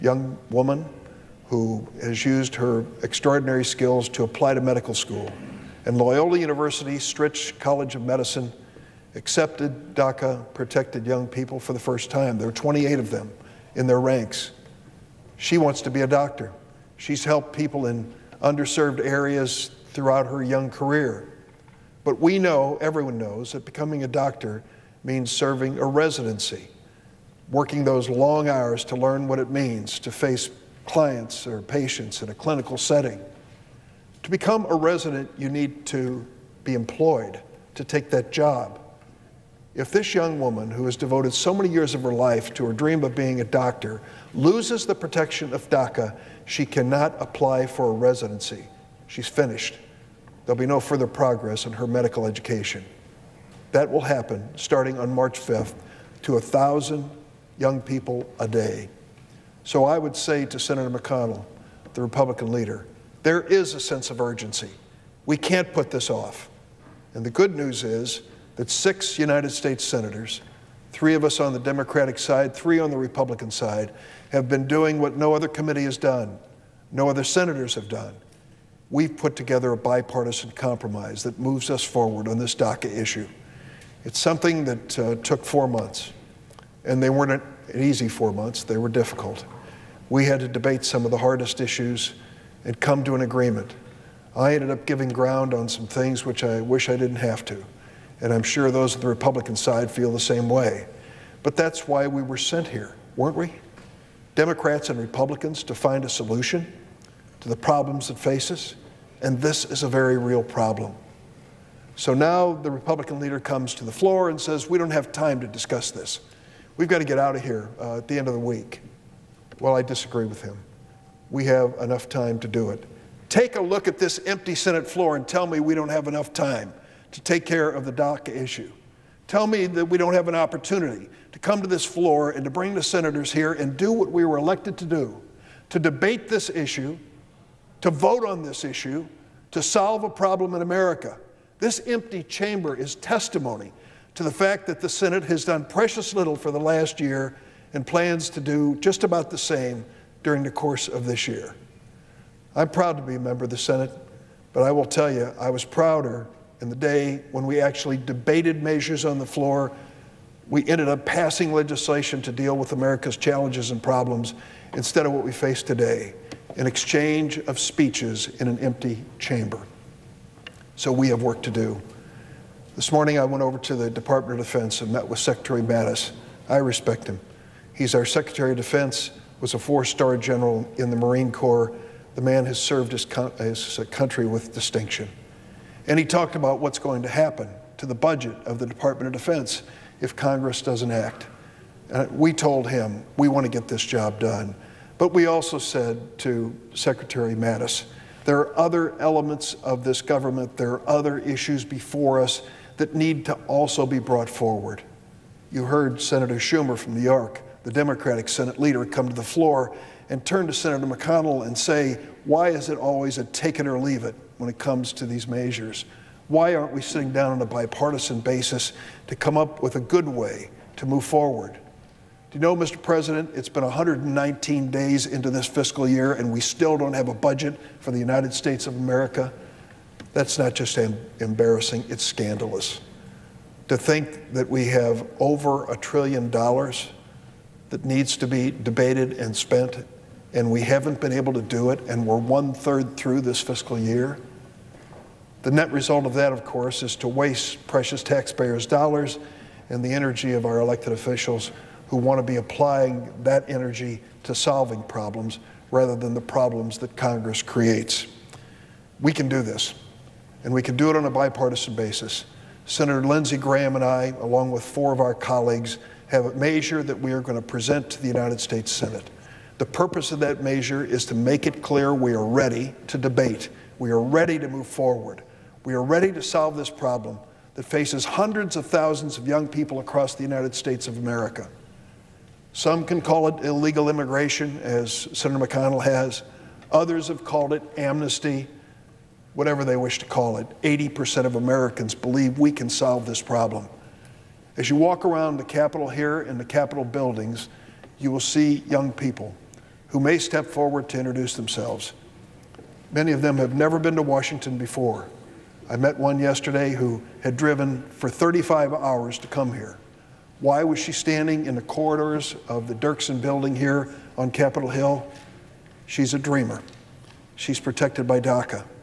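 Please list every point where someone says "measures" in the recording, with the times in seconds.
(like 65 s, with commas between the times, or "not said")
158 s, 215 s, 266 s, 270 s.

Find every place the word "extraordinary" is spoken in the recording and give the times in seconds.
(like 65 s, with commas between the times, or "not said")
3 s.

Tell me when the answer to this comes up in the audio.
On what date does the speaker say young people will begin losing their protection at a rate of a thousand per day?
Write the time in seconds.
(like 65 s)
55 s.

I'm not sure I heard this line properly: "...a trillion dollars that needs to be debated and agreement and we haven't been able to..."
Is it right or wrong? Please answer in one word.
wrong.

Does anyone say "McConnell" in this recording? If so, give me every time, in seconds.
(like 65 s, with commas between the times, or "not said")
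60 s, 210 s, 285 s.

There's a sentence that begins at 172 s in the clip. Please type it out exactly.
This morning I went over to the Department of Defense and met with Secretary Mattis.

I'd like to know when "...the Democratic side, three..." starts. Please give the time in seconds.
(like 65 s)
71 s.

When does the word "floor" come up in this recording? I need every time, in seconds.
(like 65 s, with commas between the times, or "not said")
113 s, 124 s, 131 s, 159 s, 209 s.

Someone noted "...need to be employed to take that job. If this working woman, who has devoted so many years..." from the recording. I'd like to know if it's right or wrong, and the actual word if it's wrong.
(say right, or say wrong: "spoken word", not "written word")
wrong: "young", not "working".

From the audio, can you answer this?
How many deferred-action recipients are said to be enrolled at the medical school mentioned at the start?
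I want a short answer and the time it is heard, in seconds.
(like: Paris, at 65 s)
28, at 12 s.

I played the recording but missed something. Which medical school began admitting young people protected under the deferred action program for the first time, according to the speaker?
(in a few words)
Loyola University Stritch College of Medicine.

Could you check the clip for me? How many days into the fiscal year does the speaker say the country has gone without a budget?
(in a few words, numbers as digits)
119.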